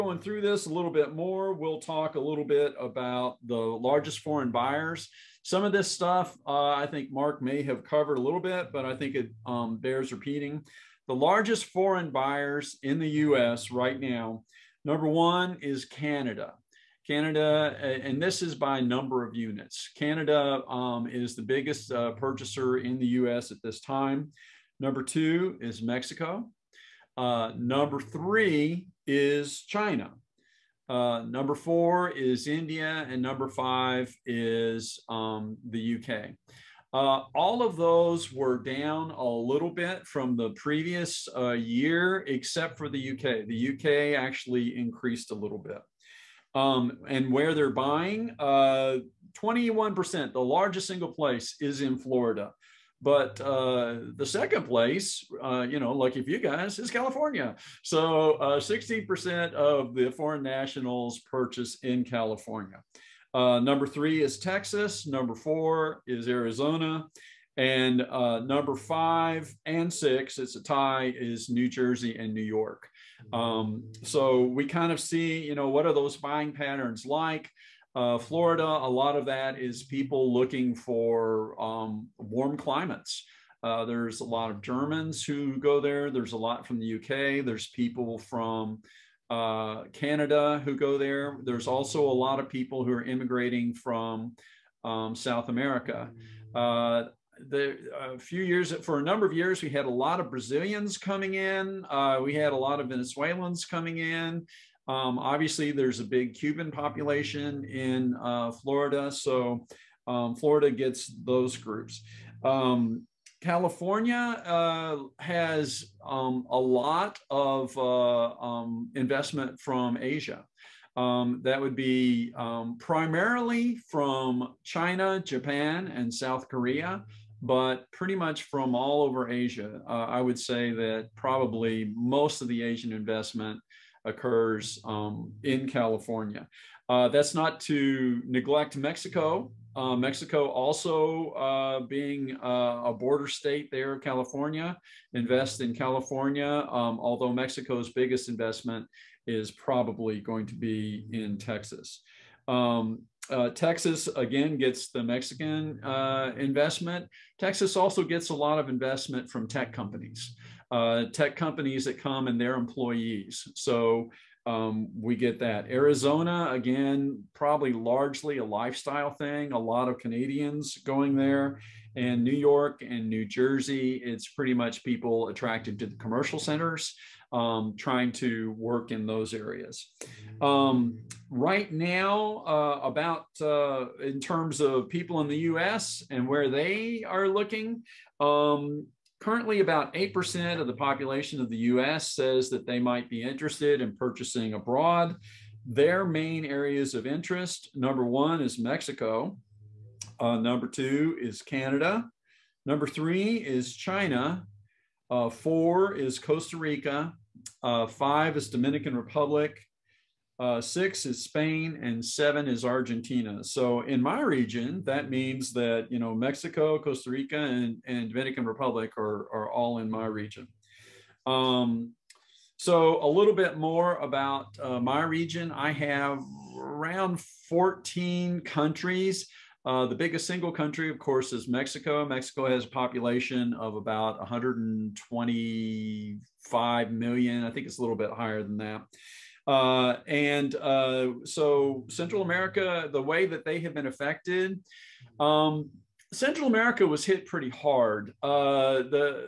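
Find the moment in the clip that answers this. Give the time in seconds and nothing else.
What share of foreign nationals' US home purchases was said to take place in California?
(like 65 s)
58 s.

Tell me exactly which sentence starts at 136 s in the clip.
Uh, that's not to neglect Mexico.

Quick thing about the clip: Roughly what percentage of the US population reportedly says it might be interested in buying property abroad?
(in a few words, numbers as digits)
8%.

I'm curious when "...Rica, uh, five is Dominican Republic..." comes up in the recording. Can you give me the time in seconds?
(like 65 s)
206 s.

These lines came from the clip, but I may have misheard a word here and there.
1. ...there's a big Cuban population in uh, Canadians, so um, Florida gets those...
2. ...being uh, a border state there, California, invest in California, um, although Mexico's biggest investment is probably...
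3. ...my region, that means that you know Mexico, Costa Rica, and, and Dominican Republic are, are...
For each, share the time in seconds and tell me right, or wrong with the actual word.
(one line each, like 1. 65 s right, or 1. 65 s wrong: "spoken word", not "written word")
1. 105 s wrong: "Florida", not "Canadians"
2. 141 s right
3. 214 s right.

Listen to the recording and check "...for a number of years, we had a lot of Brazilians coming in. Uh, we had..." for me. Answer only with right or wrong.
right.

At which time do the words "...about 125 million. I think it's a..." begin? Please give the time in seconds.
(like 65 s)
233 s.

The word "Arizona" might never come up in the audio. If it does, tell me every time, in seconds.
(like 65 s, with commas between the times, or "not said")
66 s, 165 s.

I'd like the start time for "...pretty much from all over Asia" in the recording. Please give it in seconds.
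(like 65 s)
127 s.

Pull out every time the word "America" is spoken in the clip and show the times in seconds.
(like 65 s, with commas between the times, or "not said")
95 s, 242 s, 246 s.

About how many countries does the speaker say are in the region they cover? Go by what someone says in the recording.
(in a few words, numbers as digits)
14.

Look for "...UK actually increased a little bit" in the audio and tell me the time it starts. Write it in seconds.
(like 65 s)
43 s.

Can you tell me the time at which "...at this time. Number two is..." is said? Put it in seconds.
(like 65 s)
23 s.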